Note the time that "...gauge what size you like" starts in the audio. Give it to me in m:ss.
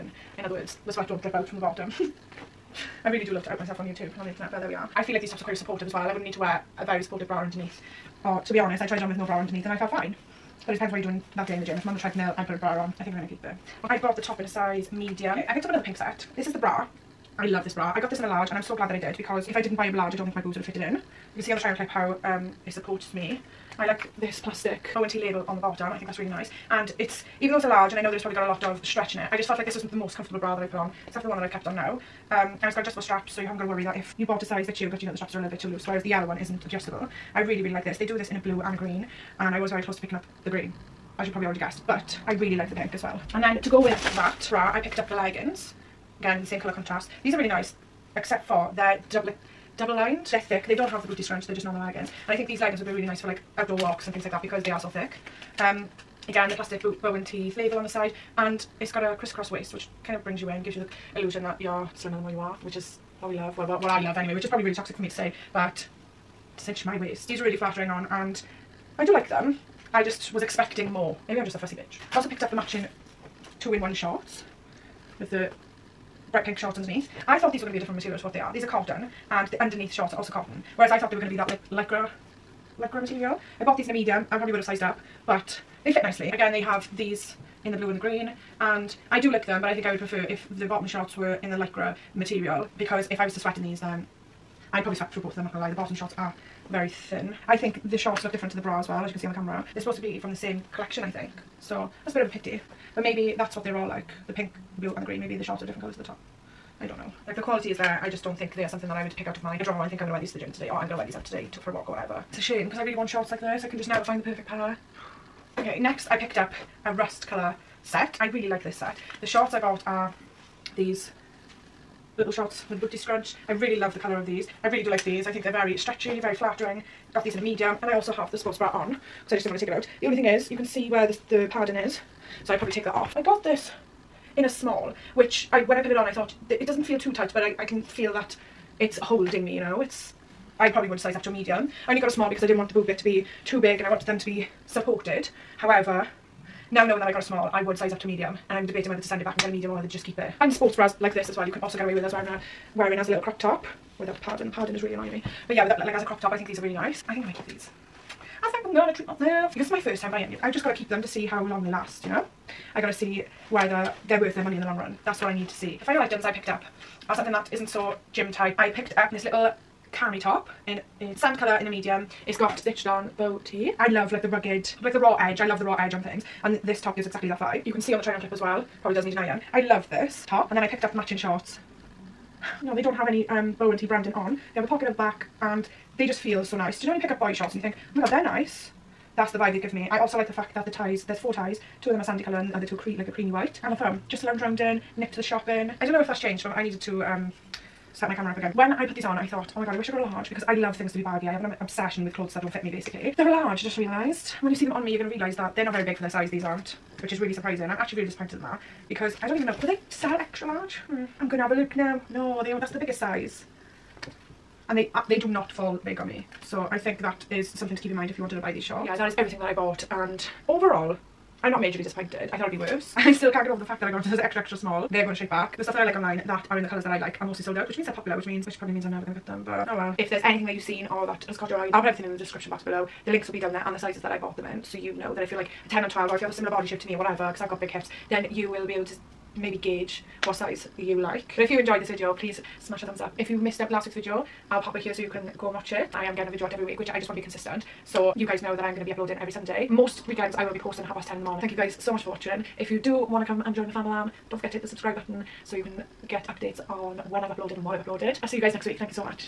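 3:59.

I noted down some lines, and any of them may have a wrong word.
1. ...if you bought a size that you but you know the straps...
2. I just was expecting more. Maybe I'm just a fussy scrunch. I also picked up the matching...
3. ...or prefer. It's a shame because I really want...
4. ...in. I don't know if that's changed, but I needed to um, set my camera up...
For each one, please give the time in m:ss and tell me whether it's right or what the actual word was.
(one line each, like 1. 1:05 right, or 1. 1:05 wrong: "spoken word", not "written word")
1. 0:33 right
2. 1:09 wrong: "bitch", not "scrunch"
3. 1:51 wrong: "whatever", not "prefer"
4. 3:15 right.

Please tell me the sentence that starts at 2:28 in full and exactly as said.
And I'm debating whether to send it back and get a medium or whether to just keep it.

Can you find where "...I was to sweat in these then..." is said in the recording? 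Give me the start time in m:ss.
1:33.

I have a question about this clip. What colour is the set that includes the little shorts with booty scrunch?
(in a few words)
Rust.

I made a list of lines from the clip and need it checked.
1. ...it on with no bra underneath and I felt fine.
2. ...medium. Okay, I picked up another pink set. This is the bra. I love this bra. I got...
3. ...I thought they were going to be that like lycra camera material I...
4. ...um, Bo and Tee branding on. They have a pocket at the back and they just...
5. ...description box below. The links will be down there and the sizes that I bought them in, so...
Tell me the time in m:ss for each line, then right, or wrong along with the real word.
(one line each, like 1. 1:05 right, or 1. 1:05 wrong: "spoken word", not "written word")
1. 0:08 right
2. 0:14 right
3. 1:20 wrong: "lycra", not "camera"
4. 3:03 right
5. 3:52 right.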